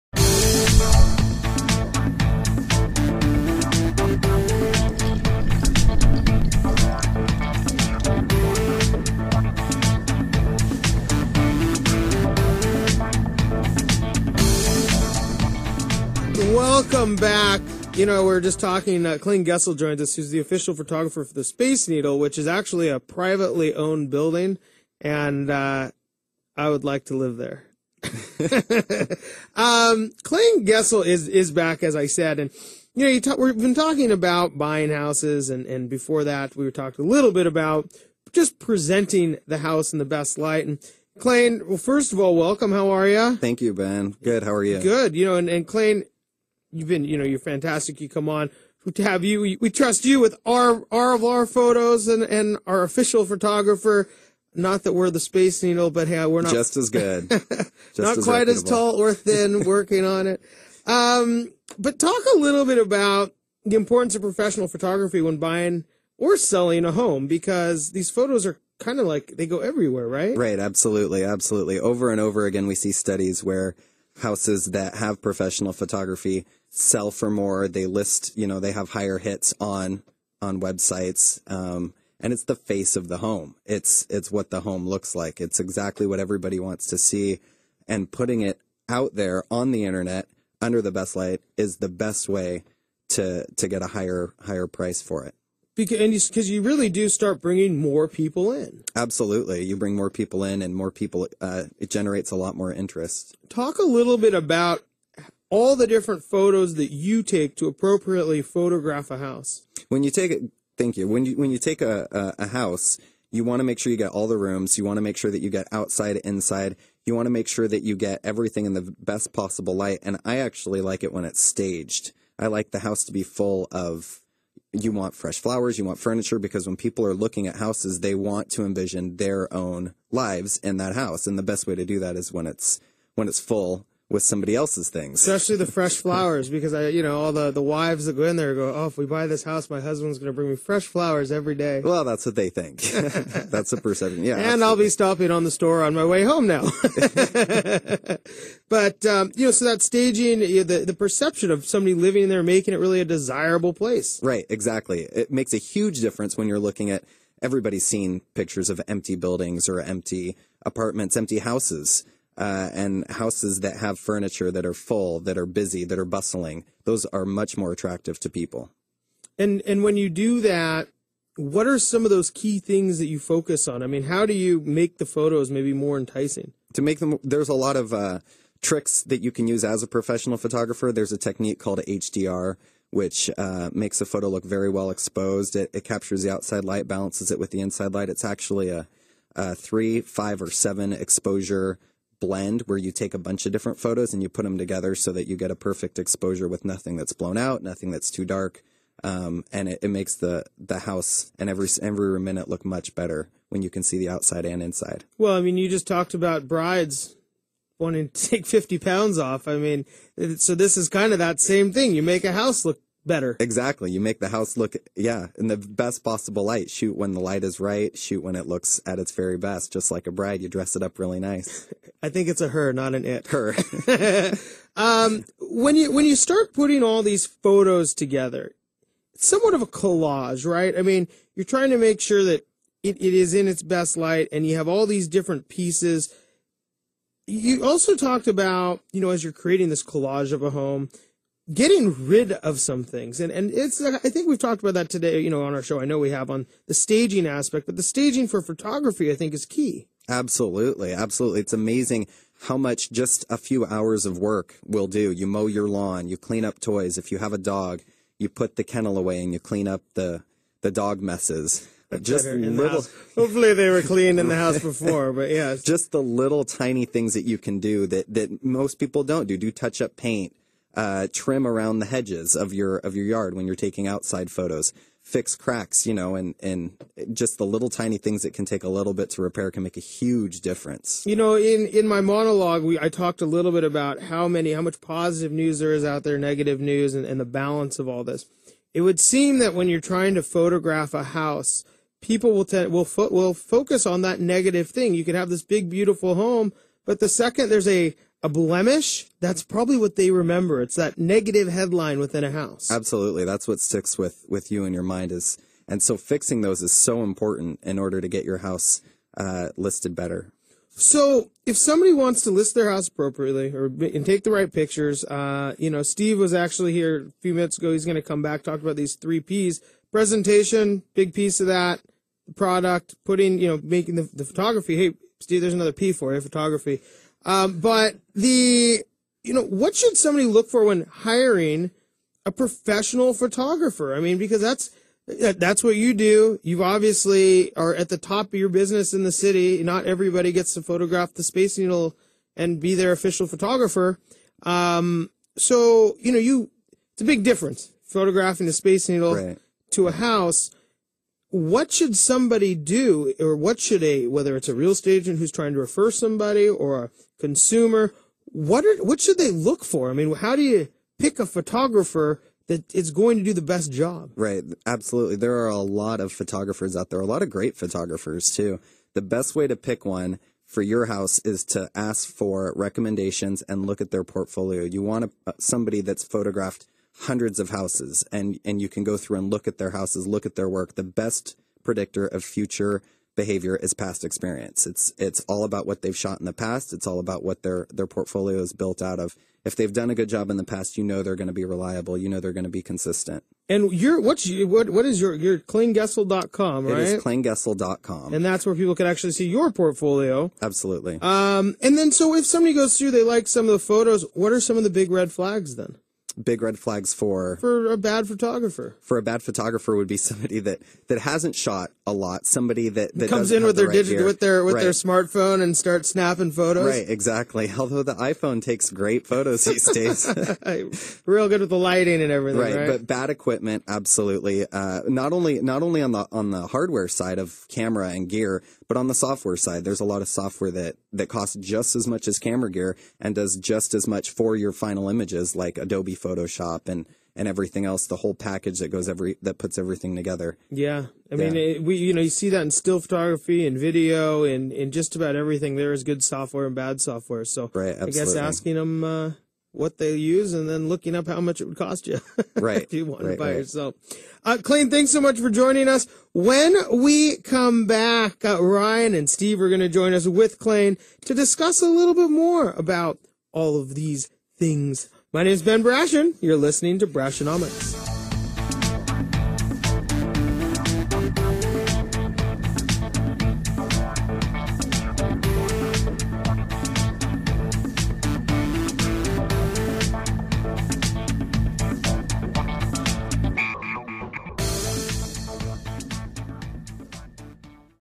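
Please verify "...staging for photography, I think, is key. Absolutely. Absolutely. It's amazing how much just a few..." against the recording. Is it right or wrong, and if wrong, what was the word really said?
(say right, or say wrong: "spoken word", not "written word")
right.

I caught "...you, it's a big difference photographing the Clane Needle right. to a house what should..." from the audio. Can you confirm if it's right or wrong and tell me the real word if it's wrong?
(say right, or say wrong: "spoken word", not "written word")
wrong: "Space", not "Clane".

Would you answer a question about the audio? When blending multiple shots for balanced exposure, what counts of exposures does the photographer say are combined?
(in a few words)
3, 5, or 7.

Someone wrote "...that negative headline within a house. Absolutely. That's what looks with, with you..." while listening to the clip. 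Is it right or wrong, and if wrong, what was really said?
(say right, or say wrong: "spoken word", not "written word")
wrong: "sticks", not "looks".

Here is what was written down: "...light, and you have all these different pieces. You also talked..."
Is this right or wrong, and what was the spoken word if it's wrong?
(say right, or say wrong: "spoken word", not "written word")
right.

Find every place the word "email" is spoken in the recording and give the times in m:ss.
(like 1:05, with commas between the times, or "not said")
not said.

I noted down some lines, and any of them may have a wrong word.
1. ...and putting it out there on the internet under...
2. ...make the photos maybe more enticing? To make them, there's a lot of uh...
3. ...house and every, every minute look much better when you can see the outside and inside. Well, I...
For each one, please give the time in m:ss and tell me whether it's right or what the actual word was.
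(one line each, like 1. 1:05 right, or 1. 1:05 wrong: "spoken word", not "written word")
1. 1:27 right
2. 2:54 right
3. 3:20 right.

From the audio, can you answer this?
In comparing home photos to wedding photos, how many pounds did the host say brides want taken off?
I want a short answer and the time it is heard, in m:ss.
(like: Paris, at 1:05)
50, at 3:28.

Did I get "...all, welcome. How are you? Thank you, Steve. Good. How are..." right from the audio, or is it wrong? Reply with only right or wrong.
wrong.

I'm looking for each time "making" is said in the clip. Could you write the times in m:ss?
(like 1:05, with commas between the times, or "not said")
2:32, 5:23.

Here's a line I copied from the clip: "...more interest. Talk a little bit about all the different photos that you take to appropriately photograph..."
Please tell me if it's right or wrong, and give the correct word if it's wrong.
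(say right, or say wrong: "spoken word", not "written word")
right.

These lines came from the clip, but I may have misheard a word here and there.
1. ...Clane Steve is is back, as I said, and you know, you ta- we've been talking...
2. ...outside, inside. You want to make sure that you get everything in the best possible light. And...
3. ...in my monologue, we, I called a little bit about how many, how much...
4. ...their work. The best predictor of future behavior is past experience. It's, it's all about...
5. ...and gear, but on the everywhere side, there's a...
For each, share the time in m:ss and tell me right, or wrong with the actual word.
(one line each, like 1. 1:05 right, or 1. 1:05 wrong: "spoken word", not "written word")
1. 0:30 wrong: "Gessel", not "Steve"
2. 1:55 right
3. 4:41 wrong: "talked", not "called"
4. 6:20 right
5. 7:07 wrong: "software", not "everywhere".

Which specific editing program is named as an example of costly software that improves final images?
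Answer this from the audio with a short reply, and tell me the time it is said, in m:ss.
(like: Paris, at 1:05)
Adobe Photoshop, at 7:15.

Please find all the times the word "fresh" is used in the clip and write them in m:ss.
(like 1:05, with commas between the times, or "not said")
2:05, 2:15, 2:20.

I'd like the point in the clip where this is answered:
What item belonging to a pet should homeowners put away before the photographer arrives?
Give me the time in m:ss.
4:18.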